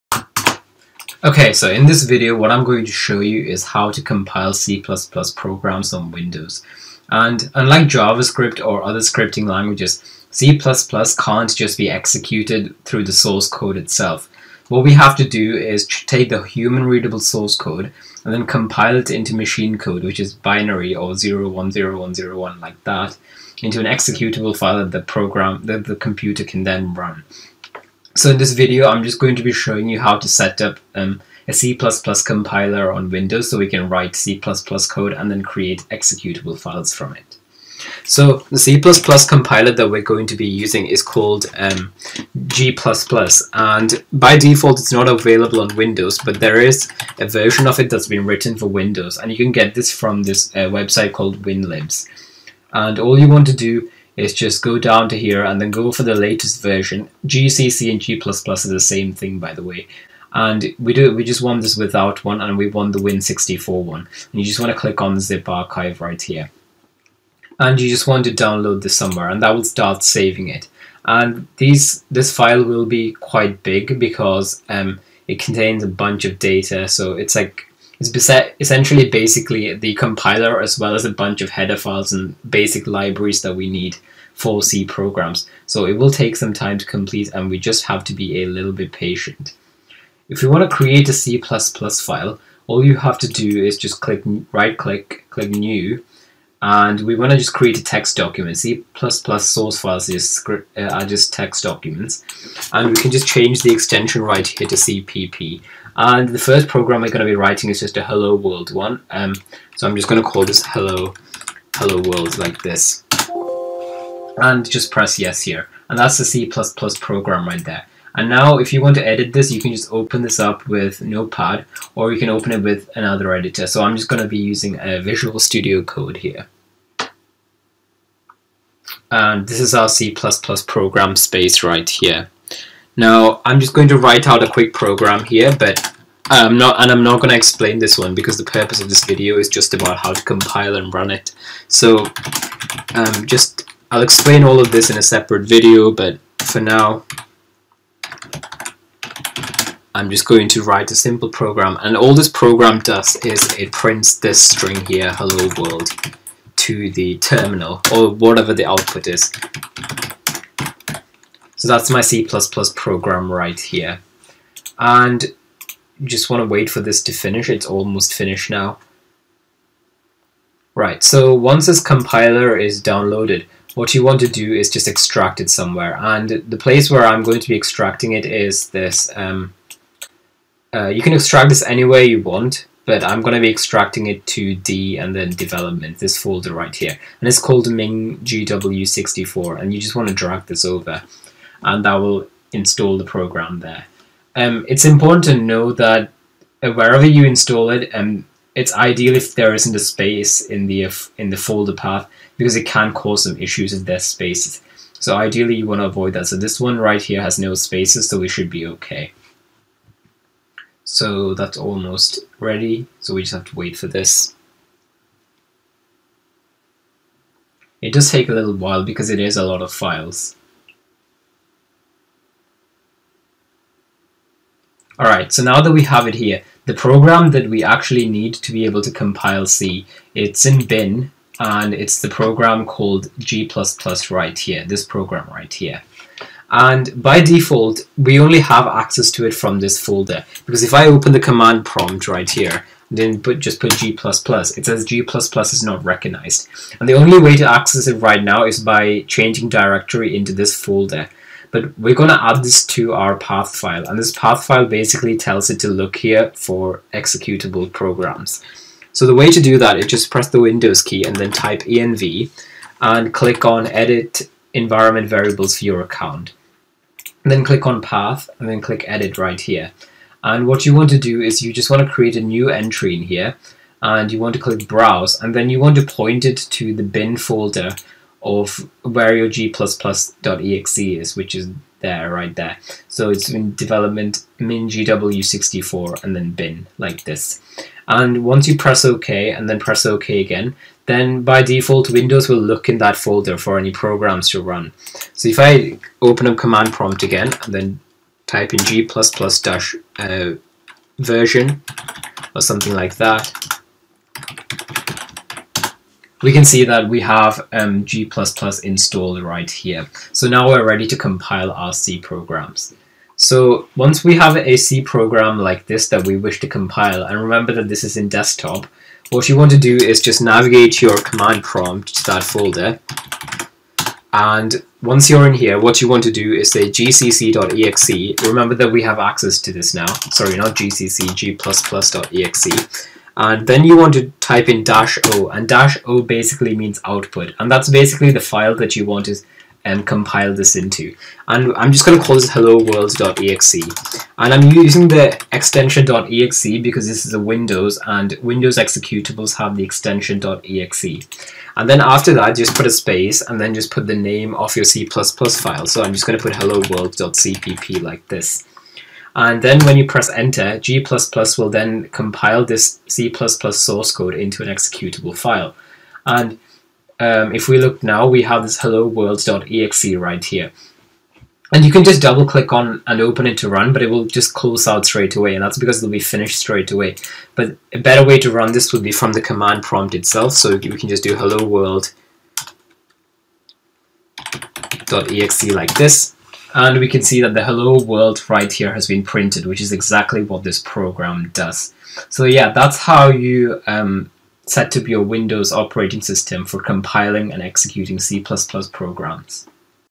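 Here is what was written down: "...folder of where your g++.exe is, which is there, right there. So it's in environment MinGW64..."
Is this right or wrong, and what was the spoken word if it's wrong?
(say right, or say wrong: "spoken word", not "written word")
wrong: "development", not "environment".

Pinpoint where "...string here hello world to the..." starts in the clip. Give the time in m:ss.
2:34.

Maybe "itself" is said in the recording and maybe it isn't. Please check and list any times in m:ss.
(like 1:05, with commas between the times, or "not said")
0:13, 6:19.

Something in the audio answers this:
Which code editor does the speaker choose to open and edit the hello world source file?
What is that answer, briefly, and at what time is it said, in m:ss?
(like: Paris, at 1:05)
Visual Studio Code, at 2:05.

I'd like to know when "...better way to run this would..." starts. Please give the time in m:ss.
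6:17.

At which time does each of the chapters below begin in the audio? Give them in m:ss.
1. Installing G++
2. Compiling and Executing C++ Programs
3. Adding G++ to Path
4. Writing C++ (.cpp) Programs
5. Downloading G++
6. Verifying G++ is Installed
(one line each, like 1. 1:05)
1. 2:45
2. 5:12
3. 3:55
4. 1:30
5. 0:38
6. 4:55.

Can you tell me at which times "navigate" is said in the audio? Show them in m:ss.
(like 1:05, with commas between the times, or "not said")
5:20.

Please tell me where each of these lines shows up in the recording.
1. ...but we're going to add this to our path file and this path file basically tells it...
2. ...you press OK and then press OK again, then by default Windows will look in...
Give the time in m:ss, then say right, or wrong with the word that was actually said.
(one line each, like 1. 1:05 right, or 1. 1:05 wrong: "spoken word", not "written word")
1. 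4:11 right
2. 4:48 right.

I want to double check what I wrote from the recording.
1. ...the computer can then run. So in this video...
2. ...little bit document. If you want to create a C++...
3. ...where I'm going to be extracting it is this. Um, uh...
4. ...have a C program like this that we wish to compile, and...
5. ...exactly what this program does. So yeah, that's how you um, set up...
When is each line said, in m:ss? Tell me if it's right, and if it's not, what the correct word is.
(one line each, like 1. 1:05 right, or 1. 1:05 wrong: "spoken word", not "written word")
1. 0:25 right
2. 1:28 wrong: "patient", not "document"
3. 2:56 right
4. 5:14 right
5. 6:29 right.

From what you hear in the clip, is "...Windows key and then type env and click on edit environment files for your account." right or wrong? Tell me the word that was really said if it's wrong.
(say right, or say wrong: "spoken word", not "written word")
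wrong: "variables", not "files".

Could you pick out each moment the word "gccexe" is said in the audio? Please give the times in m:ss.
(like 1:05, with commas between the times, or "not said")
5:26.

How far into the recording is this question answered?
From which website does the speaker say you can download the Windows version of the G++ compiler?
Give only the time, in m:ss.
0:51.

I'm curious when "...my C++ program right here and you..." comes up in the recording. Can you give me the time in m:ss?
2:41.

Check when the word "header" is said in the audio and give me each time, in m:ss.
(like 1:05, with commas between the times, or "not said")
1:21.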